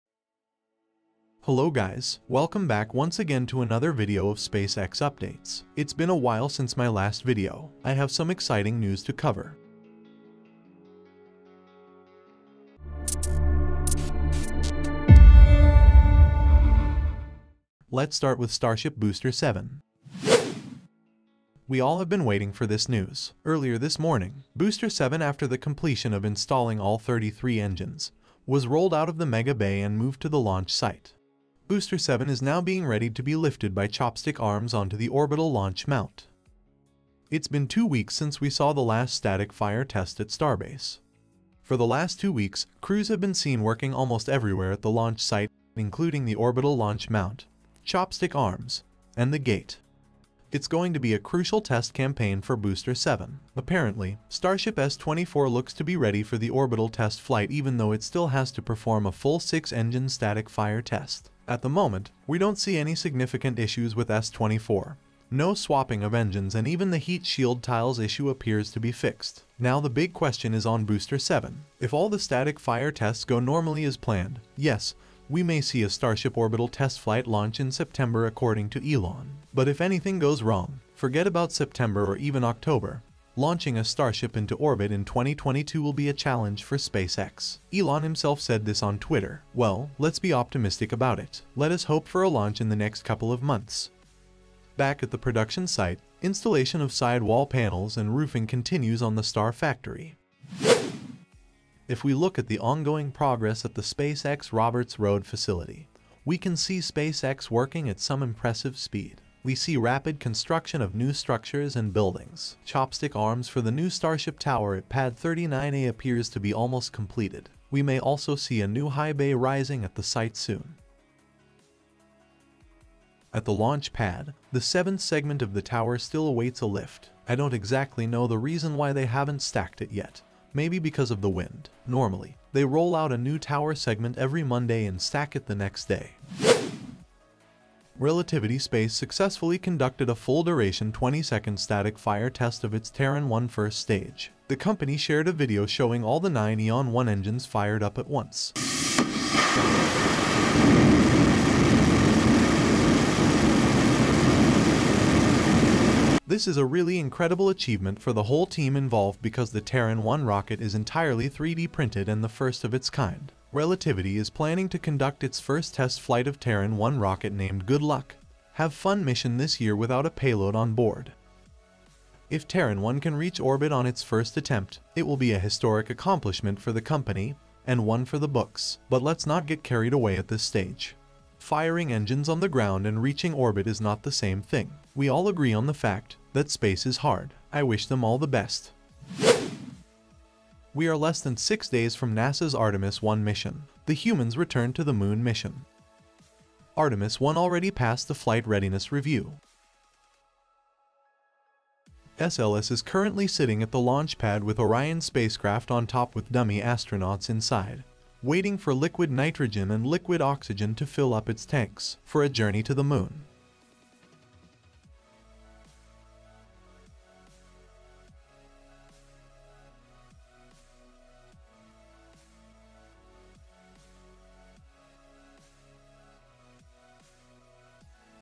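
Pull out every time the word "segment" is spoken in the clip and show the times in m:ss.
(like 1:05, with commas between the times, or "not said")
2:05, 2:13.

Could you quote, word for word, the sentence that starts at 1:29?
Well, let's be optimistic about it.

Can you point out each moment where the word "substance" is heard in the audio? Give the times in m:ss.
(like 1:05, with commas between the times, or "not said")
not said.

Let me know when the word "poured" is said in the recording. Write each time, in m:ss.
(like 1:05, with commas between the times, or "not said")
not said.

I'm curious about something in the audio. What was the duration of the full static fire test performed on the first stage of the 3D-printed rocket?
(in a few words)
20 seconds.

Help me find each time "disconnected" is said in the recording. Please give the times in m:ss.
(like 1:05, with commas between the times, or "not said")
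not said.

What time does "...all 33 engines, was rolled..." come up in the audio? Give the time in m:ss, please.
0:26.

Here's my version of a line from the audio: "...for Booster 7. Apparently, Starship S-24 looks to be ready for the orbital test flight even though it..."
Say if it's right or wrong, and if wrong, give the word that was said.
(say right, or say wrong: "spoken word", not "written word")
right.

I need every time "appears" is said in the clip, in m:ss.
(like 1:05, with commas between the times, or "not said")
1:08, 1:55.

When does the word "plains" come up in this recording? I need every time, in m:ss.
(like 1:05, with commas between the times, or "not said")
not said.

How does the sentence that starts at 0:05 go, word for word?
It's been a while since my last video.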